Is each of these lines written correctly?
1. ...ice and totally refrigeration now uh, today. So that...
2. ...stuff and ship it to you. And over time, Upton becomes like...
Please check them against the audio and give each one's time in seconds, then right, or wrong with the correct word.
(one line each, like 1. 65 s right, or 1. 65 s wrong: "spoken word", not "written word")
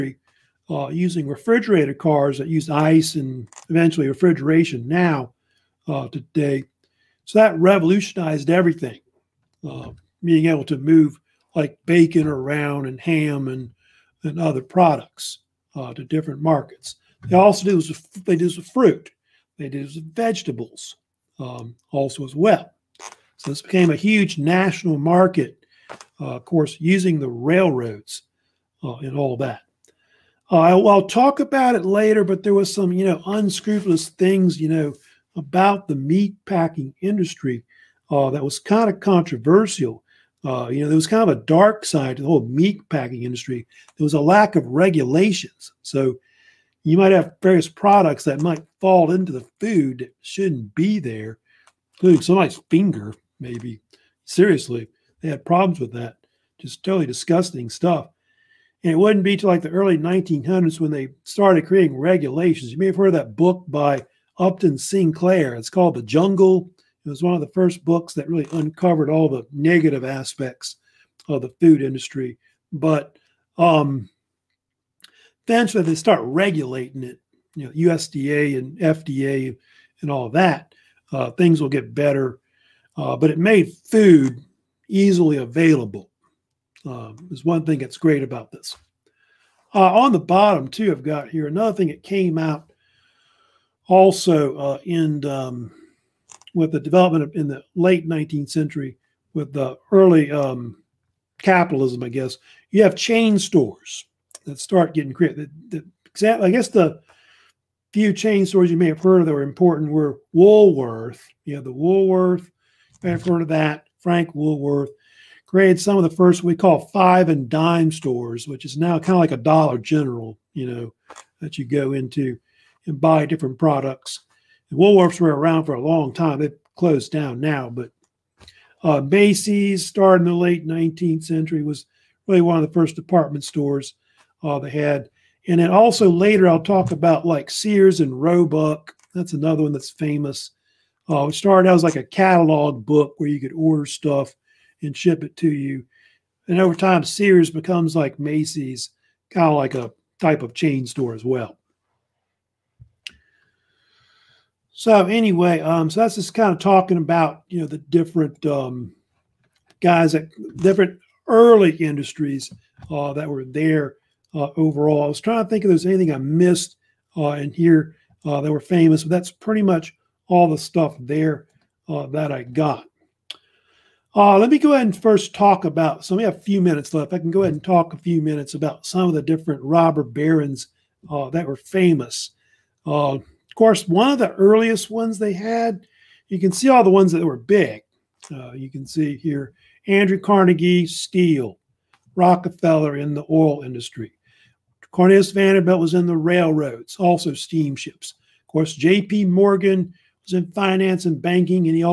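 1. 2 s wrong: "eventually", not "totally"
2. 143 s wrong: "Sears", not "Upton".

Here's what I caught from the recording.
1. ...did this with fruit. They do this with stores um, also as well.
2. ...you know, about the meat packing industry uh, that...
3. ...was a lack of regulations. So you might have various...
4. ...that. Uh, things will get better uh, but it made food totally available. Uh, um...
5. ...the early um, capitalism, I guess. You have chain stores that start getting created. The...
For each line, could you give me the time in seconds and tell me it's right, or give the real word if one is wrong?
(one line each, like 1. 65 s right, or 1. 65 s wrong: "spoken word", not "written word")
1. 18 s wrong: "vegetables", not "stores"
2. 34 s right
3. 44 s right
4. 80 s wrong: "easily", not "totally"
5. 99 s right.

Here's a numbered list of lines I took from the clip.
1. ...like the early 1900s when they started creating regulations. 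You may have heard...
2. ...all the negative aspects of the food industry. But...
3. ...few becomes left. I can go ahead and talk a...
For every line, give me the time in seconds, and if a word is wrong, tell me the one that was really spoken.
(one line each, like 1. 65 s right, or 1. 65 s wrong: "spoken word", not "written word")
1. 59 s right
2. 69 s right
3. 176 s wrong: "minutes", not "becomes".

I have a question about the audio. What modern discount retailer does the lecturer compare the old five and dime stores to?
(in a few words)
Dollar General.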